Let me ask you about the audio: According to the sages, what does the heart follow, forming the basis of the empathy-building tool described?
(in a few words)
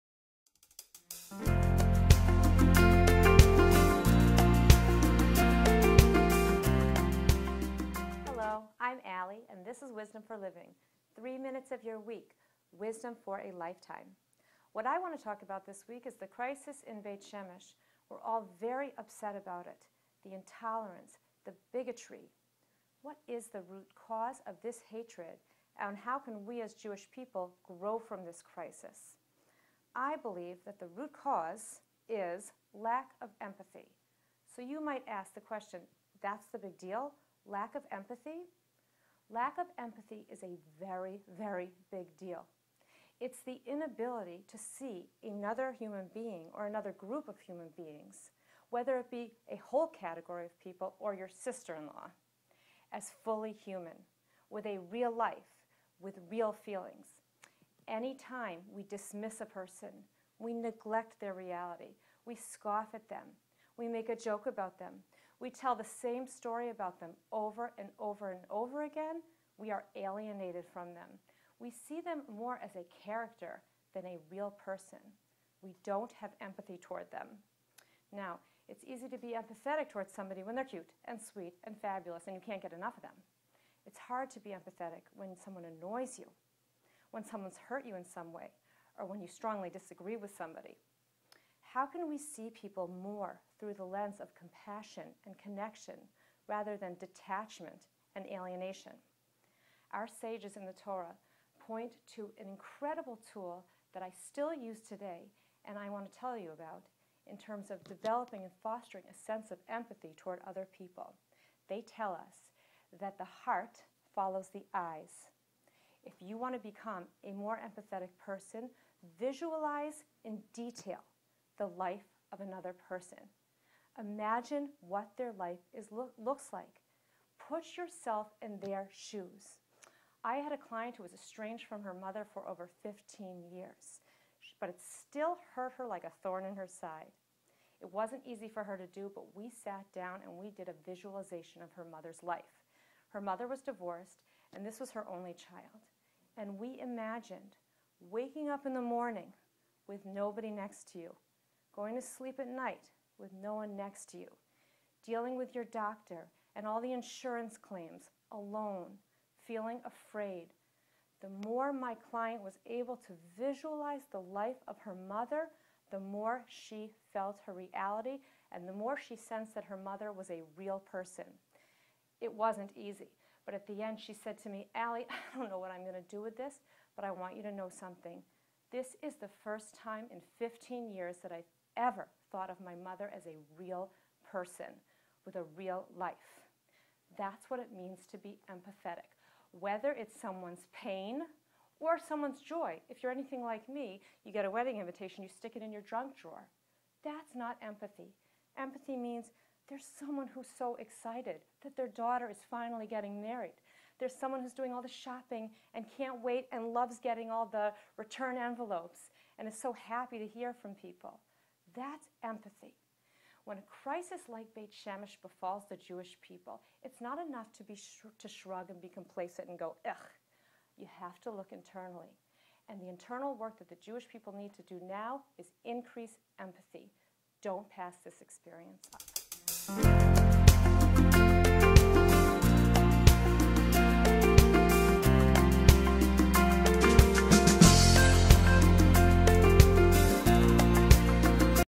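The eyes.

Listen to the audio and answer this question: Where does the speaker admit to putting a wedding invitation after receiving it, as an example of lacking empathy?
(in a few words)
Junk drawer.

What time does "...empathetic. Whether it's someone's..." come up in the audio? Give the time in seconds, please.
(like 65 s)
188 s.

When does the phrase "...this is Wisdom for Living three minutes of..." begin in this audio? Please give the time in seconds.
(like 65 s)
9 s.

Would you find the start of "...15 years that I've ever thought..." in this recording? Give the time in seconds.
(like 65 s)
180 s.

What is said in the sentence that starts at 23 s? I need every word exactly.
What is the root cause of this hatred, and how can we as Jewish people grow from this crisis?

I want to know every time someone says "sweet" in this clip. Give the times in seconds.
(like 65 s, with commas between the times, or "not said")
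81 s.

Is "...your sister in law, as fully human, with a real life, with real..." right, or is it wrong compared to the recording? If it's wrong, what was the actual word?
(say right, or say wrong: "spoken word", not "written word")
right.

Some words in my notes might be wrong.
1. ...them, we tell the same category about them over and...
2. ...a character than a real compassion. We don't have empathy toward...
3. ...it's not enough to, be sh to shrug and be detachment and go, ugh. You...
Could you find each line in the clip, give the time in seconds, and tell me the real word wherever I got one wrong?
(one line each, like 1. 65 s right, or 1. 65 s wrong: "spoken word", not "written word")
1. 64 s wrong: "story", not "category"
2. 72 s wrong: "person", not "compassion"
3. 216 s wrong: "complacent", not "detachment".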